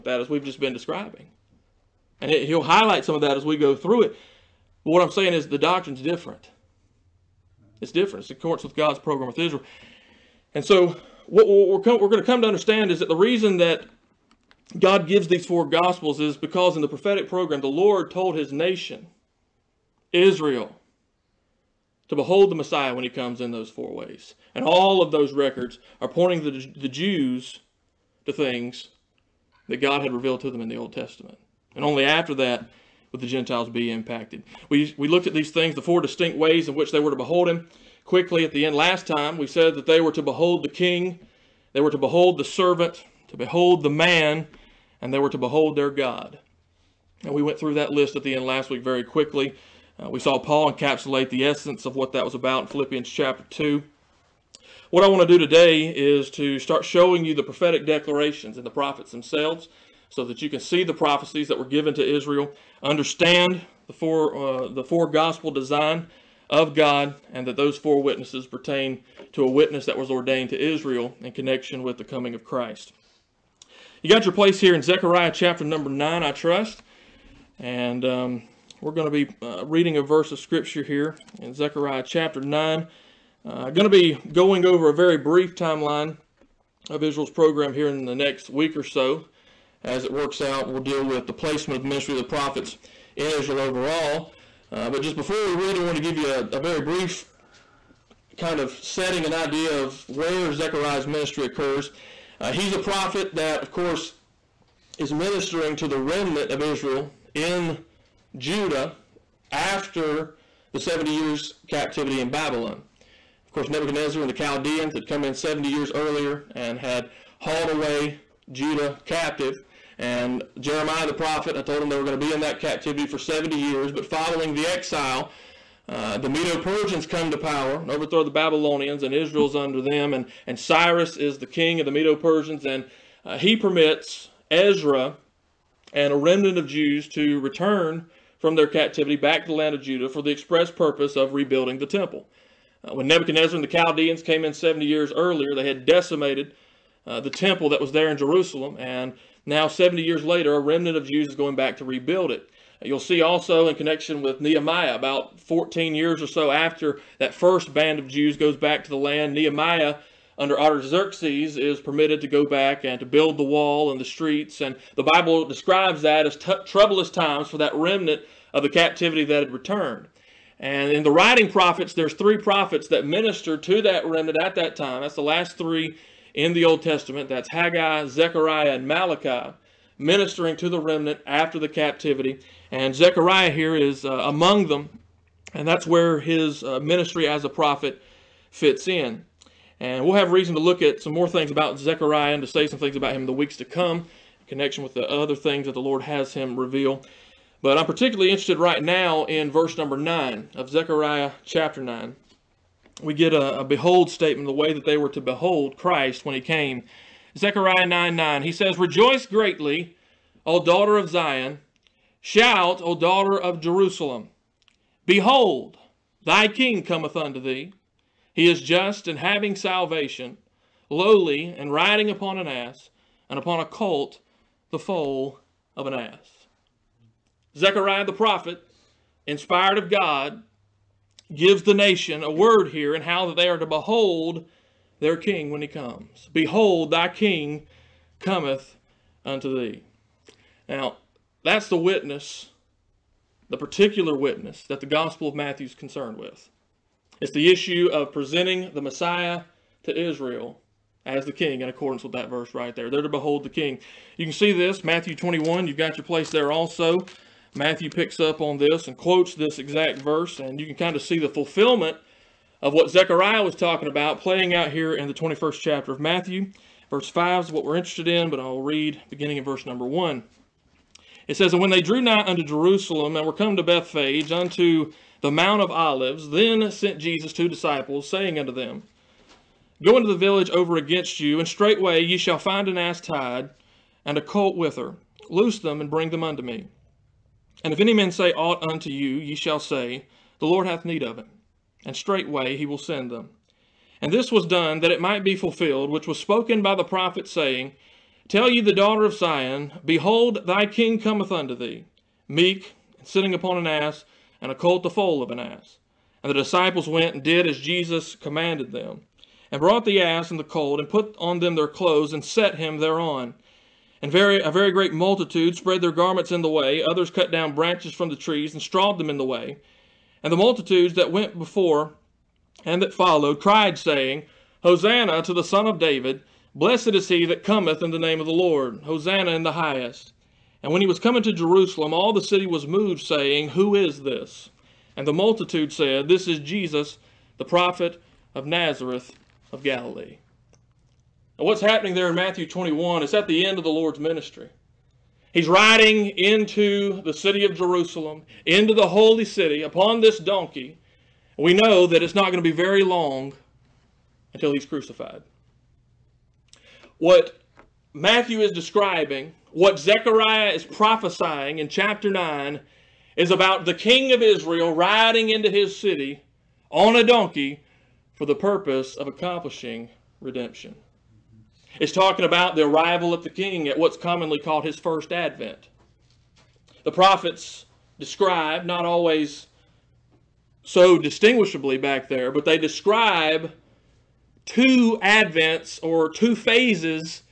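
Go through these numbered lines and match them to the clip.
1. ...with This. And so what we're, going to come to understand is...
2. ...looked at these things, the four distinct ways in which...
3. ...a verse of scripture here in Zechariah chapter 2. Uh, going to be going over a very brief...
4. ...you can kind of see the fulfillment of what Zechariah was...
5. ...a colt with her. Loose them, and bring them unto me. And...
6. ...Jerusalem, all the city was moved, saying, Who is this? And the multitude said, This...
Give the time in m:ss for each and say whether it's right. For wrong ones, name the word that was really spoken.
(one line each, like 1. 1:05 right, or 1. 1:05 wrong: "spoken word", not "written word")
1. 0:09 wrong: "Israel", not "This"
2. 0:35 right
3. 1:19 wrong: "9", not "2"
4. 4:20 right
5. 4:44 right
6. 5:31 right.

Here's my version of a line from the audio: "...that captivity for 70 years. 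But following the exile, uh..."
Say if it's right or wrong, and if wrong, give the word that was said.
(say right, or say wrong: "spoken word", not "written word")
right.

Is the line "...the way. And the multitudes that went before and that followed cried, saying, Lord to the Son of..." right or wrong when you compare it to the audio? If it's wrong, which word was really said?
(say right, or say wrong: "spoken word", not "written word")
wrong: "Hosanna", not "Lord".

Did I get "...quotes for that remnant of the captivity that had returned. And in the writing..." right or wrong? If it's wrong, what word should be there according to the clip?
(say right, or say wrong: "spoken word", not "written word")
wrong: "times", not "quotes".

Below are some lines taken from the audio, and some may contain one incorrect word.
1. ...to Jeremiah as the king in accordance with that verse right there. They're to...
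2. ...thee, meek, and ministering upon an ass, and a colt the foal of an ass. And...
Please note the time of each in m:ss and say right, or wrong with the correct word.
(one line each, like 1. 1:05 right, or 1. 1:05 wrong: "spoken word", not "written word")
1. 4:09 wrong: "Israel", not "Jeremiah"
2. 5:01 wrong: "sitting", not "ministering".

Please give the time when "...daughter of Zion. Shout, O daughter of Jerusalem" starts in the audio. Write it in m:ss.
3:30.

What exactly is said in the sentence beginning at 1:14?
You got your place here in Zechariah chapter number 9, I trust.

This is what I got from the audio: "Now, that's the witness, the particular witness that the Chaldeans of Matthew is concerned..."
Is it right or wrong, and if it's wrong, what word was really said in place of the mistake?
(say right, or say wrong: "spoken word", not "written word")
wrong: "Gospel", not "Chaldeans".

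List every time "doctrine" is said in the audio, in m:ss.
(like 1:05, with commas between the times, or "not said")
0:05.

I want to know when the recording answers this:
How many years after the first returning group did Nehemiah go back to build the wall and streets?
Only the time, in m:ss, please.
2:35.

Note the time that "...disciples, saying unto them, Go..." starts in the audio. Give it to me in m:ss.
4:37.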